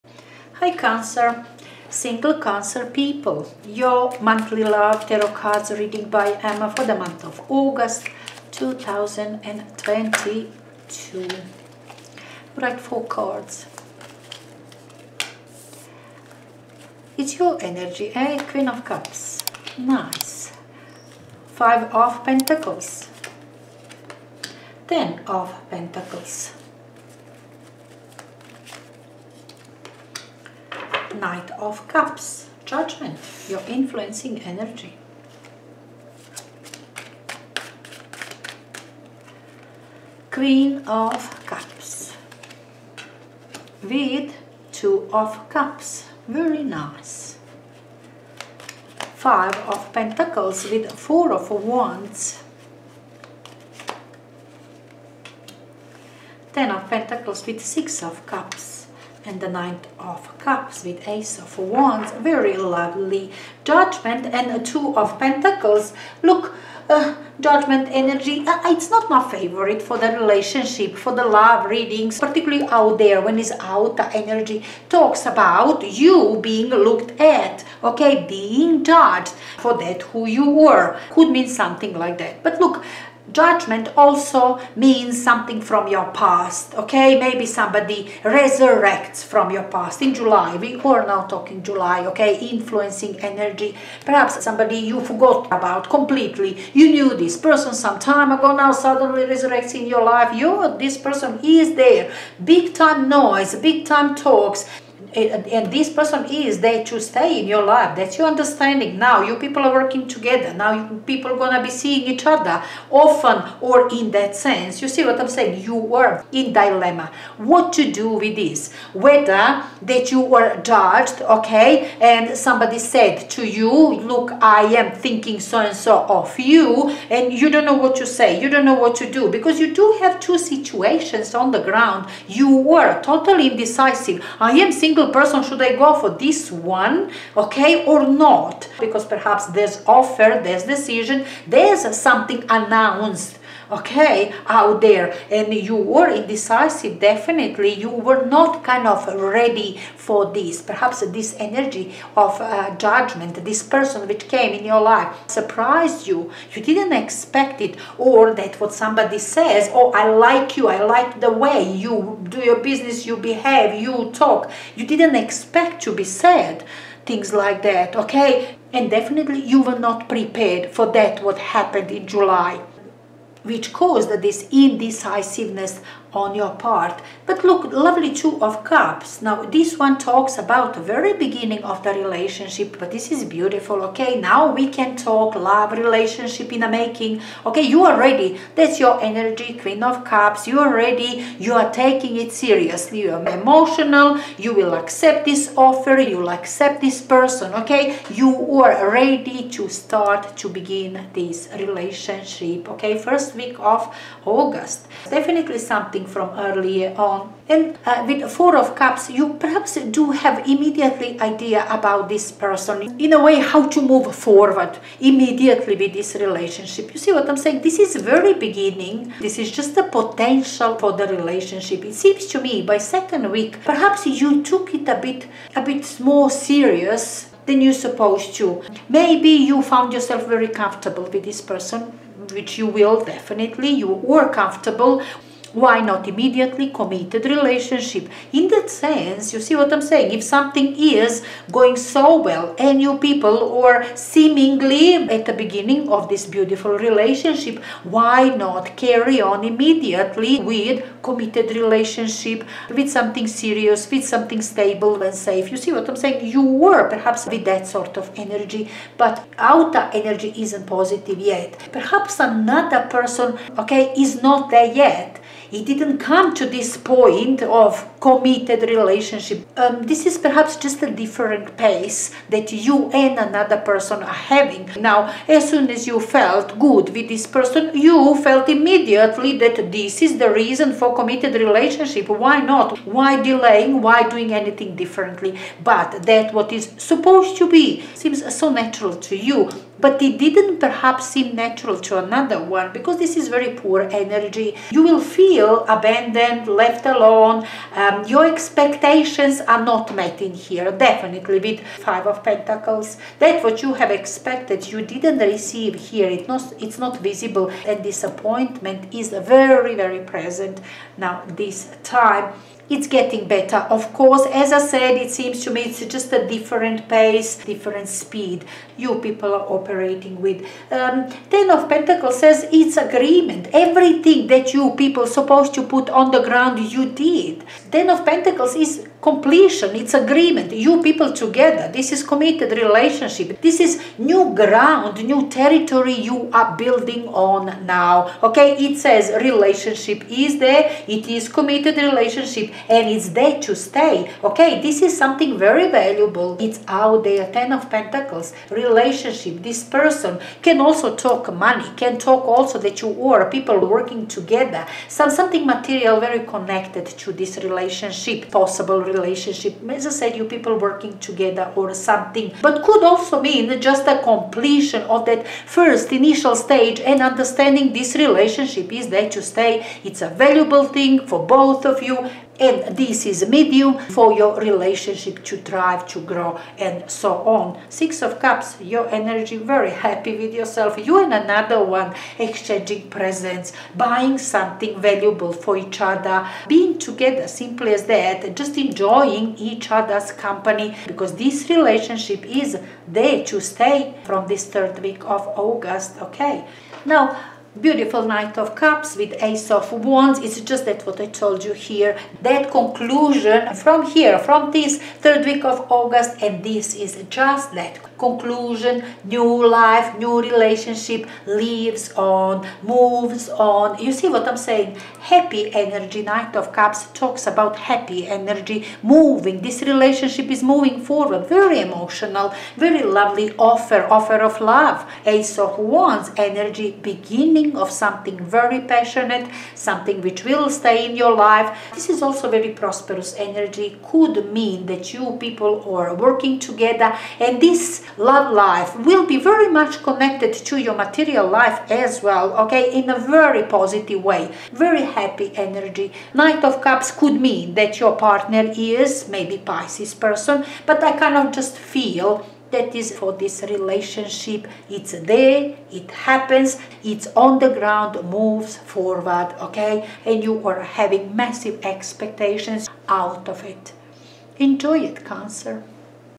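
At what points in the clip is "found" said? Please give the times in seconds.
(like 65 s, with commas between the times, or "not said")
229 s.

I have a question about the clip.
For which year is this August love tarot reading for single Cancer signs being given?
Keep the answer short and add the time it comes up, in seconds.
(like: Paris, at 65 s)
2022, at 8 s.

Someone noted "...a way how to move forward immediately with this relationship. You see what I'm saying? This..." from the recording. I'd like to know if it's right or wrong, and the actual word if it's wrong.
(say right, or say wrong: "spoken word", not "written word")
right.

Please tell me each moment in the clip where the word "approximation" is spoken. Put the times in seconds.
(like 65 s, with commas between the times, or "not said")
not said.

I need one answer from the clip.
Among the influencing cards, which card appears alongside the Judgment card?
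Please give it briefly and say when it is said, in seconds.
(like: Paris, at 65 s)
Two of Pentacles, at 64 s.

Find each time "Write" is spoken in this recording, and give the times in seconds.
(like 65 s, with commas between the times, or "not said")
12 s.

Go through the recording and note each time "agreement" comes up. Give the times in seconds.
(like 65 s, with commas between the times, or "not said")
322 s, 329 s.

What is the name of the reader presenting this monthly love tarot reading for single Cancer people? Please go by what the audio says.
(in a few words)
Emma.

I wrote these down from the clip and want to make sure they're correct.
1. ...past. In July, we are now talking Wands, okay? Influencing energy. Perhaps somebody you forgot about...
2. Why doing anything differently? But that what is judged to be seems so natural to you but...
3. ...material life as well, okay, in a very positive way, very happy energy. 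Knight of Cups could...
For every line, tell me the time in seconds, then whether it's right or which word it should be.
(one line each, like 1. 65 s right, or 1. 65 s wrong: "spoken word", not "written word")
1. 89 s wrong: "July", not "Wands"
2. 283 s wrong: "supposed", not "judged"
3. 440 s right.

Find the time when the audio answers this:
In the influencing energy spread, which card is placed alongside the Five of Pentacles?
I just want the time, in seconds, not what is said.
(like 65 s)
50 s.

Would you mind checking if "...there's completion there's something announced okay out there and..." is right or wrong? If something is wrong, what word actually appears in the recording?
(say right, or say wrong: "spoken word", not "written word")
wrong: "decision", not "completion".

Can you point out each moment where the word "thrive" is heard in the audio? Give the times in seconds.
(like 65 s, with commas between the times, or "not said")
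375 s.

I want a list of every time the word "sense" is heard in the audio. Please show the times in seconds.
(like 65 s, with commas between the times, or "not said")
114 s, 238 s.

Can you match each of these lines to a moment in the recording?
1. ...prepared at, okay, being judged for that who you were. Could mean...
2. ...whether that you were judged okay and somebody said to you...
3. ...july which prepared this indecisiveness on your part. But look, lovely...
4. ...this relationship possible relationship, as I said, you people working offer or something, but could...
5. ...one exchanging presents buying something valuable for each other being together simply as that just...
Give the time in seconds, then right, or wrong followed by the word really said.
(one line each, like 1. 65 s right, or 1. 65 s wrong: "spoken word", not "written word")
1. 76 s wrong: "looked", not "prepared"
2. 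118 s right
3. 172 s wrong: "caused", not "prepared"
4. 357 s wrong: "together", not "offer"
5. 381 s right.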